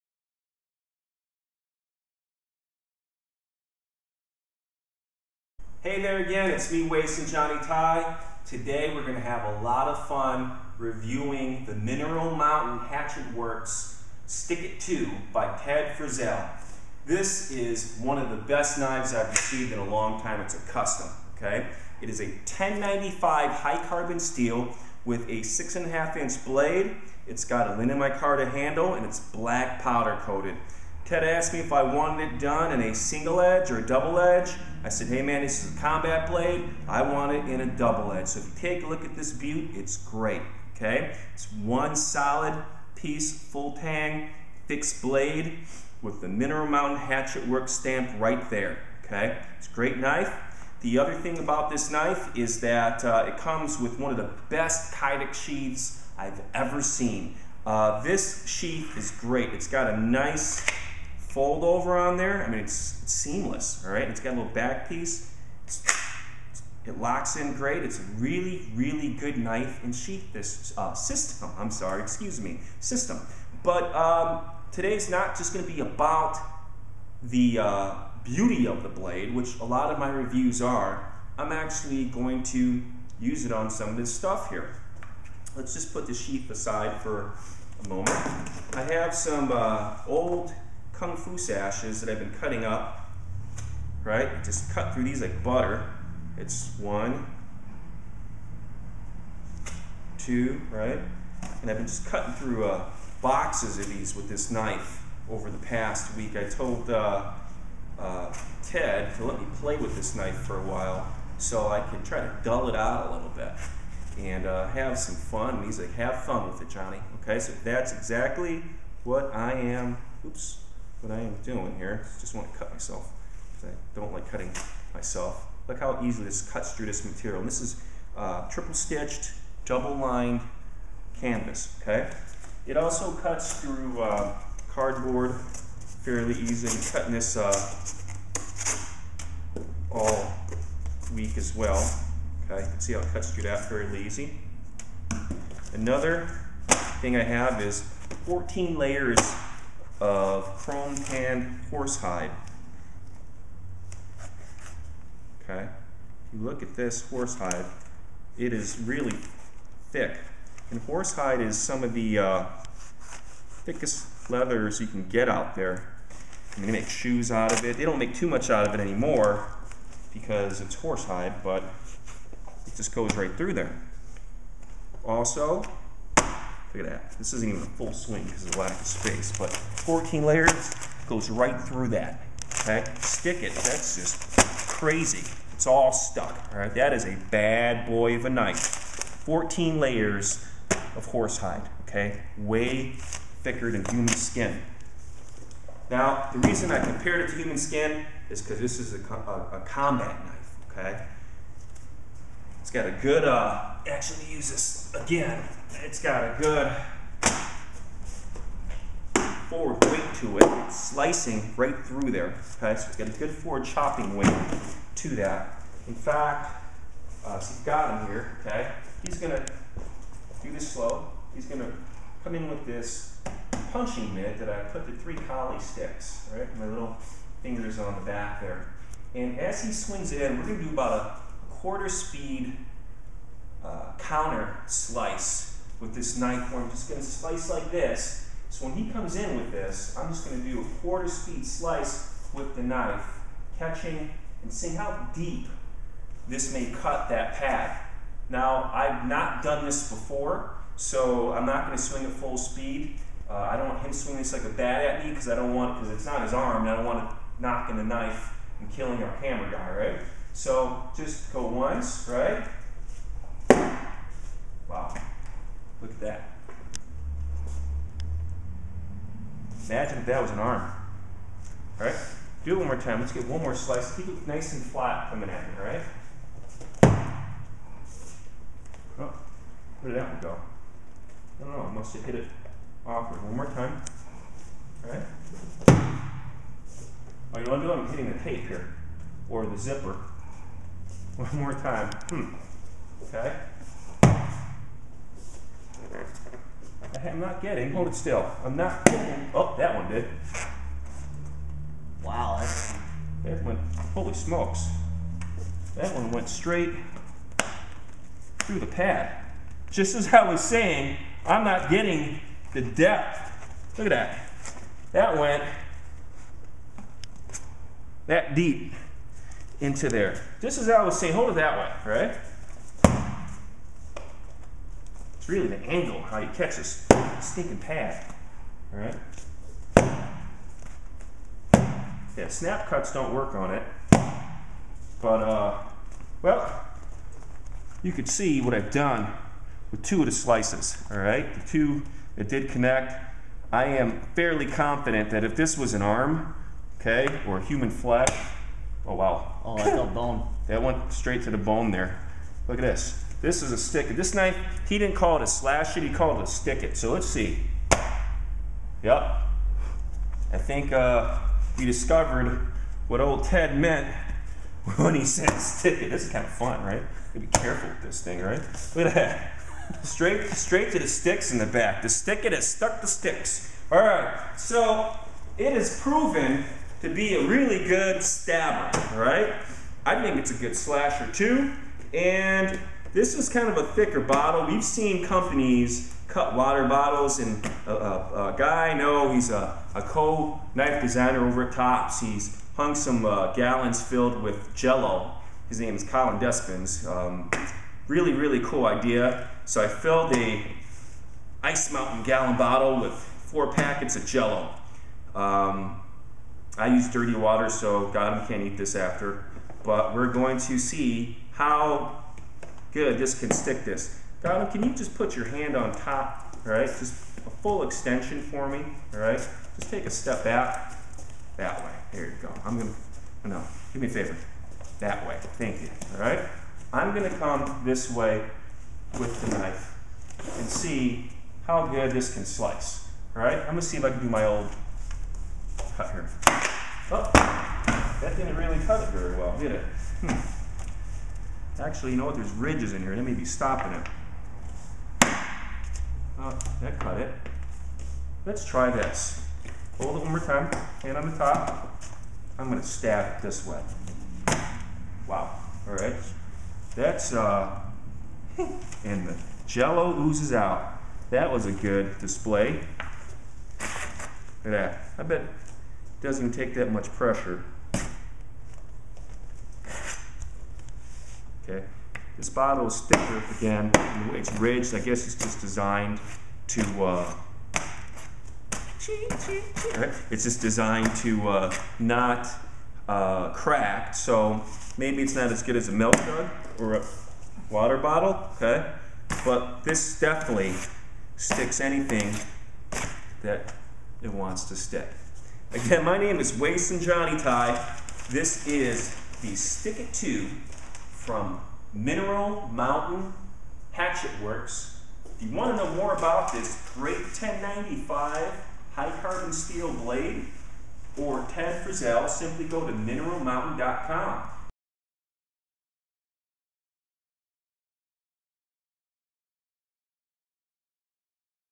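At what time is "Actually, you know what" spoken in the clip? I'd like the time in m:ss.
7:21.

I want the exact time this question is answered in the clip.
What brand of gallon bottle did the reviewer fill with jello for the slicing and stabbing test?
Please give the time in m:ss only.
6:41.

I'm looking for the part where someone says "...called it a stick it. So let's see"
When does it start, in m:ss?
5:55.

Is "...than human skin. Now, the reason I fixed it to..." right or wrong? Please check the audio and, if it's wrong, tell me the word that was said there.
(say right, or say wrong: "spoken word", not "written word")
wrong: "compared", not "fixed".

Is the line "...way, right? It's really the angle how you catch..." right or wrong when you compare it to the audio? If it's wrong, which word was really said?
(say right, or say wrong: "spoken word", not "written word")
right.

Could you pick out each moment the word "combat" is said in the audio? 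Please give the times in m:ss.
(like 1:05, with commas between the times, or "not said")
0:35, 3:19.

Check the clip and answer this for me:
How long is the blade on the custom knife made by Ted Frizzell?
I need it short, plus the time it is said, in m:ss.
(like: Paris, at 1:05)
6.5 inches, at 0:25.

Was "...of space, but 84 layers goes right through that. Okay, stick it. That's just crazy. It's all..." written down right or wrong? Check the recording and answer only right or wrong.
wrong.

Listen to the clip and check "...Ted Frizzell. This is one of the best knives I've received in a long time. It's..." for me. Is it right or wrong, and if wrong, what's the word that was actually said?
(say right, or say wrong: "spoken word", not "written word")
right.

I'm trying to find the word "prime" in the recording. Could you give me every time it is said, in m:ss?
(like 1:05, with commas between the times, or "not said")
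not said.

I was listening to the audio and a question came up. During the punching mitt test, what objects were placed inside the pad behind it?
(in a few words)
Three kali sticks.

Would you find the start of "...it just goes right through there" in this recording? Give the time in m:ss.
2:52.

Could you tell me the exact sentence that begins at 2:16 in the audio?
I'm cutting this uh, all week as well, okay?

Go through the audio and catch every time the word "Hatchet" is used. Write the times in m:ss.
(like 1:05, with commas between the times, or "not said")
0:12, 0:46, 8:23.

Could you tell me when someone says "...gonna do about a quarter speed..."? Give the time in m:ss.
3:50.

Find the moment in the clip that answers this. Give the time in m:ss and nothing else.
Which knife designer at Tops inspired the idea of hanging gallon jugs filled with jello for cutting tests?
6:35.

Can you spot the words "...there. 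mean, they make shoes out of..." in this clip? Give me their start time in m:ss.
2:45.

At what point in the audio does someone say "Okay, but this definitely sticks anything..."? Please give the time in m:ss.
8:08.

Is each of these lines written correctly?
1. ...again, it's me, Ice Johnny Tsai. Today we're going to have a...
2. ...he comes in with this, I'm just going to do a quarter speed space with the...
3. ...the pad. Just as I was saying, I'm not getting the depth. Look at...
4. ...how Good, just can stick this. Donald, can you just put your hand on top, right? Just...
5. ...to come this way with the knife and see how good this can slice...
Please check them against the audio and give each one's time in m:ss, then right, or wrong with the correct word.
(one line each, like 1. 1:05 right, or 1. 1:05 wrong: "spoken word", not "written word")
1. 0:06 wrong: "Waysun", not "Ice"
2. 3:58 wrong: "slice", not "space"
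3. 5:08 right
4. 6:51 right
5. 7:07 right.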